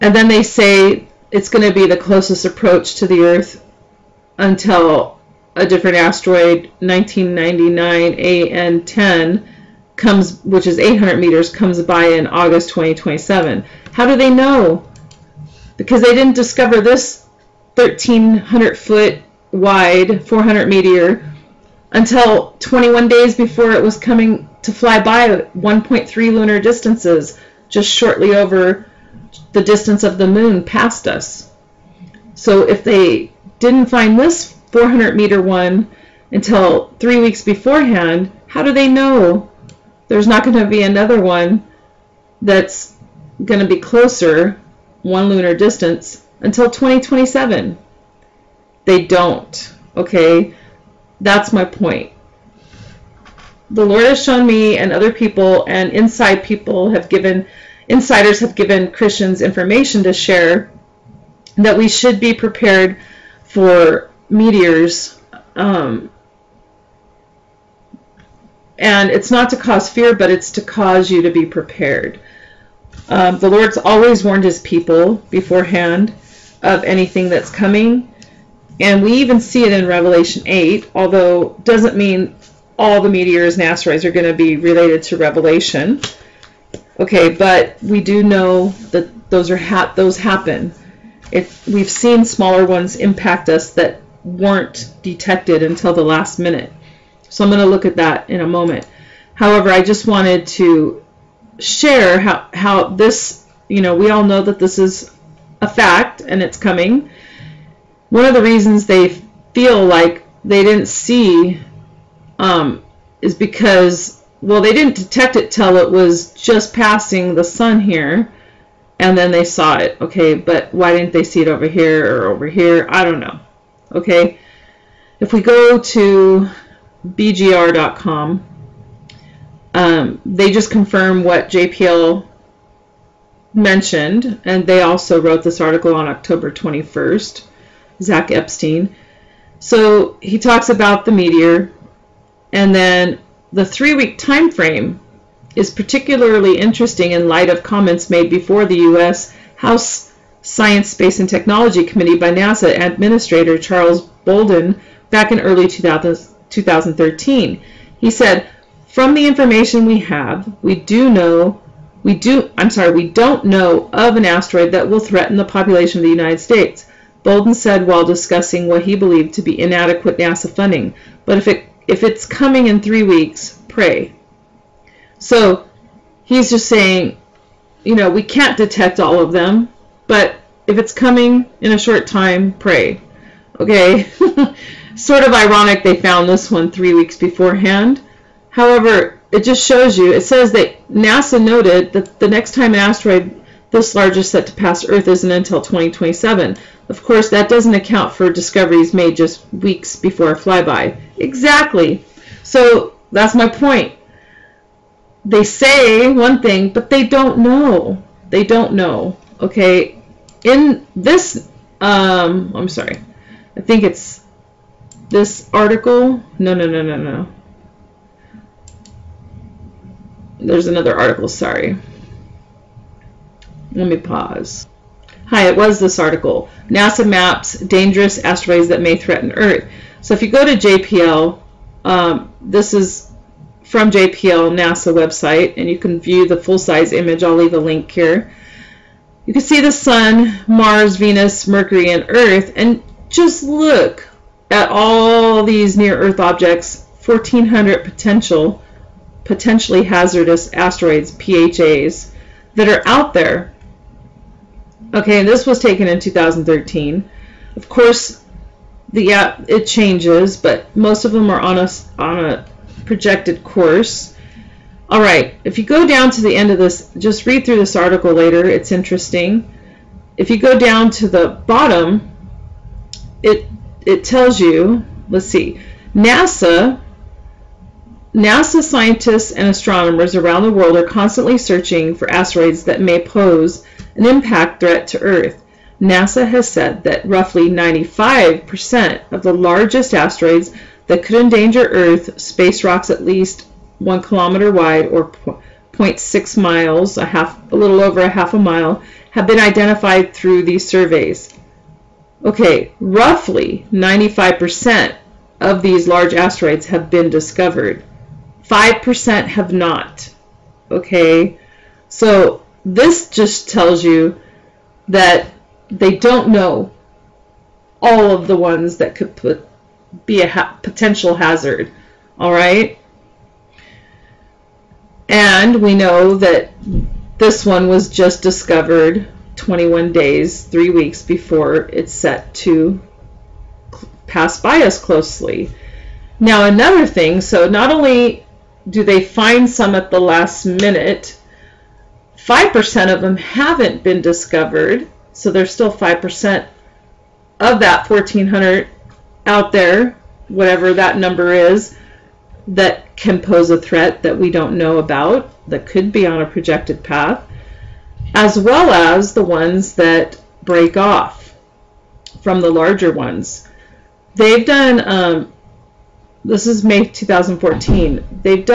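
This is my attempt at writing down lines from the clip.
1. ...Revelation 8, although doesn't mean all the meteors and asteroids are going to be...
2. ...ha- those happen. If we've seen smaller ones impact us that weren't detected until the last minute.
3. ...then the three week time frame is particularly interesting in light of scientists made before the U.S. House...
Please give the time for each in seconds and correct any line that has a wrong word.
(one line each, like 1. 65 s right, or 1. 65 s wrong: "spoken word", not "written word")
1. 79 s right
2. 89 s right
3. 142 s wrong: "comments", not "scientists".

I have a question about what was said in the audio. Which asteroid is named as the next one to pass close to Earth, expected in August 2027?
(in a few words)
1999 AN10.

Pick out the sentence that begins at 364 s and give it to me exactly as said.
They've done um, this is May 2014.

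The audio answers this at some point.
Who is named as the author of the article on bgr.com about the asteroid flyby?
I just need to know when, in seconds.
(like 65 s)
138 s.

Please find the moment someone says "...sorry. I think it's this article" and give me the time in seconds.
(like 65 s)
212 s.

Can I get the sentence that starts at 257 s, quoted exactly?
Of course, the yeah, it changes, but most of them are on a on a projected course.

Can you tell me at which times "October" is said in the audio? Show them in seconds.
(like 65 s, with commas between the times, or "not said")
136 s.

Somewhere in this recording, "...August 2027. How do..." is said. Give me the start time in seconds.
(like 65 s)
12 s.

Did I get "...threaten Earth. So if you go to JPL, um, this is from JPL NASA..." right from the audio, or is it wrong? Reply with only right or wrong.
right.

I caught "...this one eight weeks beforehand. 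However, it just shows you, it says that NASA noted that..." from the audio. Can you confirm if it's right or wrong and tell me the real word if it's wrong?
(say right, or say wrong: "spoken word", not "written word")
wrong: "three", not "eight".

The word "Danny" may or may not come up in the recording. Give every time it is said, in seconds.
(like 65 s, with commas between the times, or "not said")
not said.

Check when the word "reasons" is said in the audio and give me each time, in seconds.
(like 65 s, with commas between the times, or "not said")
108 s.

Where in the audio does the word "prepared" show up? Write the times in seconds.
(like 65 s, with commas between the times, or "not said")
62 s, 71 s.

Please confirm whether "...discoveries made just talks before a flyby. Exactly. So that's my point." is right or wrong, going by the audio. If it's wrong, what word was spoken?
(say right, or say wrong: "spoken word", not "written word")
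wrong: "weeks", not "talks".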